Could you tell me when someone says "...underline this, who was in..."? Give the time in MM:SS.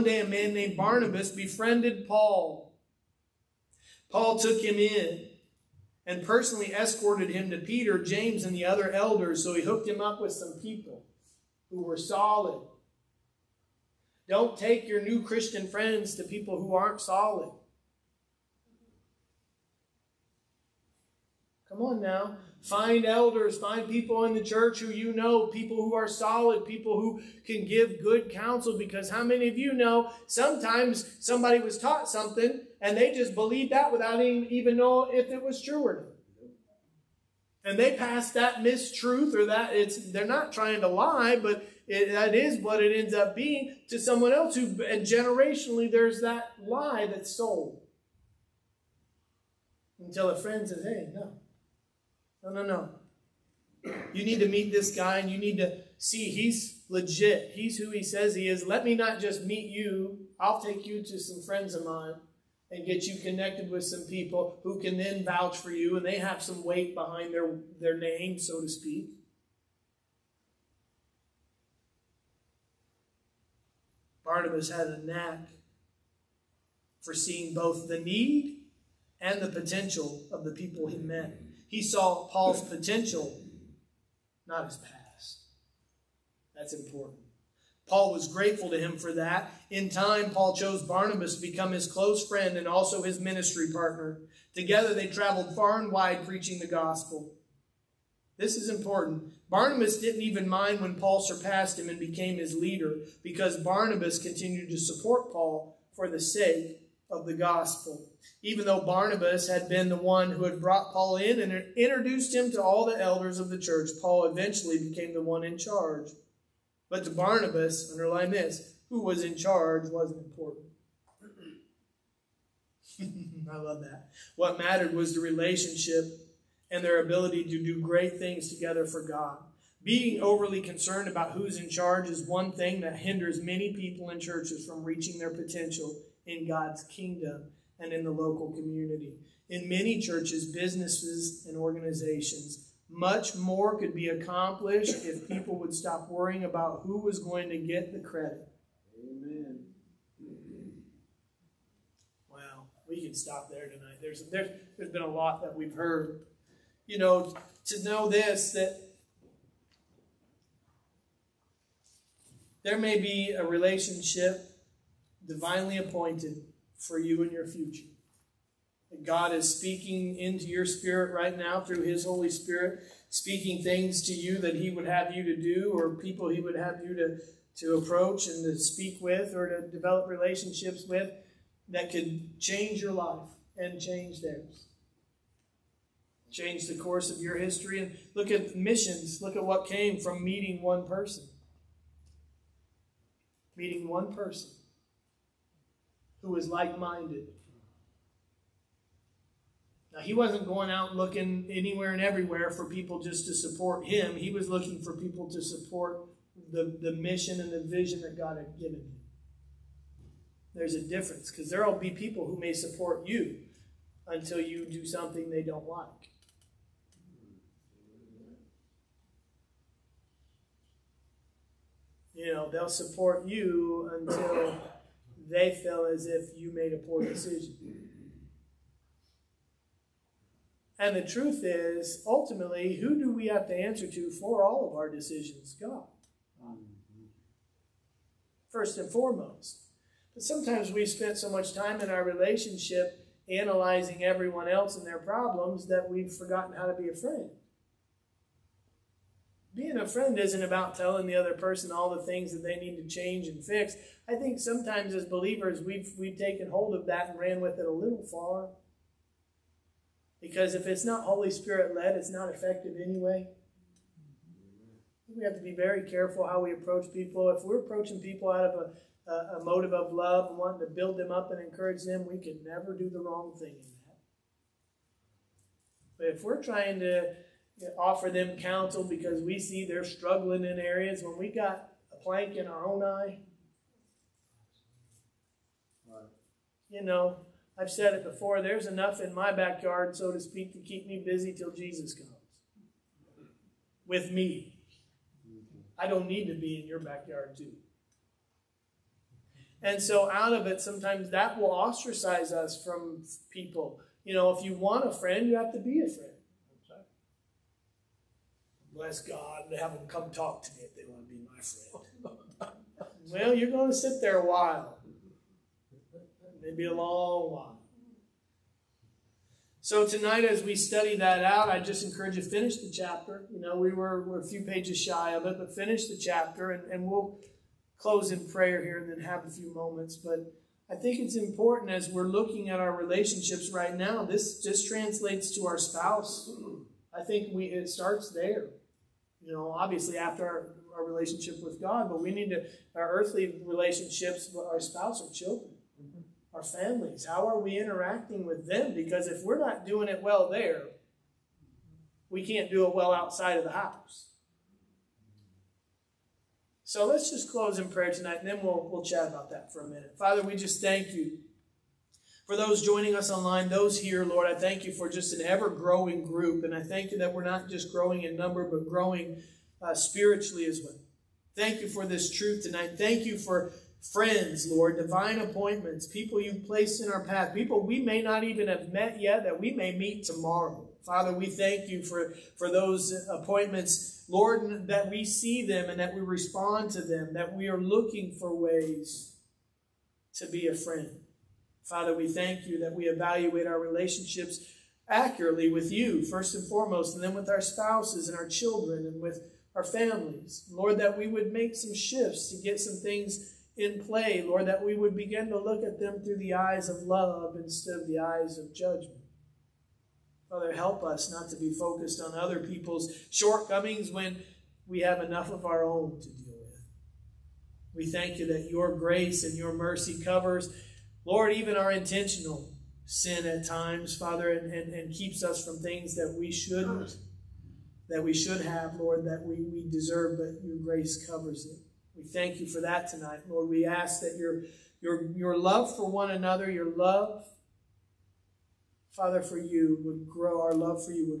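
01:57.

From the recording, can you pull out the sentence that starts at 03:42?
You know, they'll support you until they feel as if you made a poor decision.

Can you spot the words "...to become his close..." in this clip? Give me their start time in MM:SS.
01:31.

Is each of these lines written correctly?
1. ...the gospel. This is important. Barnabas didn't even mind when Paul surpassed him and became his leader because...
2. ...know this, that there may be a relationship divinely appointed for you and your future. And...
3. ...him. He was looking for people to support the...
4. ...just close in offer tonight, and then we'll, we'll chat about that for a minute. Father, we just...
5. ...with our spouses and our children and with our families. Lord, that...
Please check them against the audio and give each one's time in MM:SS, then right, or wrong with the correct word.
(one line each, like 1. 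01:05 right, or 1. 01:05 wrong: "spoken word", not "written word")
1. 01:36 right
2. 02:37 right
3. 03:23 right
4. 05:57 wrong: "prayer", not "offer"
5. 06:37 right.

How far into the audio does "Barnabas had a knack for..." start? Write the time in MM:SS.
01:14.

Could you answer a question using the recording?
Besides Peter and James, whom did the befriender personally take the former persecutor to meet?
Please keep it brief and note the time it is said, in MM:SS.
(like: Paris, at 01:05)
the other elders, at 00:08.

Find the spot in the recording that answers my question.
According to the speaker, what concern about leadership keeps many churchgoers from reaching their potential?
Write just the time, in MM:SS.
02:11.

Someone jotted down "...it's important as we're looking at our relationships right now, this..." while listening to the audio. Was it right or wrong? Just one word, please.
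right.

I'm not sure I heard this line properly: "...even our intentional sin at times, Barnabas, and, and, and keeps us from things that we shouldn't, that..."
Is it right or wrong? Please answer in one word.
wrong.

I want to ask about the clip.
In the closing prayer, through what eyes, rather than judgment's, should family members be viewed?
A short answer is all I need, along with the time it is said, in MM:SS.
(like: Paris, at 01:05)
the eyes of love, at 06:46.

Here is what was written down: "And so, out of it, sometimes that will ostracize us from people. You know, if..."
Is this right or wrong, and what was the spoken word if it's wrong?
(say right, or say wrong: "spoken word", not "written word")
right.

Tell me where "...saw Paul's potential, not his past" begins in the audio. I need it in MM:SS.
01:21.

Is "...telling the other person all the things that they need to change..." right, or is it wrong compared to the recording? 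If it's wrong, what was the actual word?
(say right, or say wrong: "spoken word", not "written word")
right.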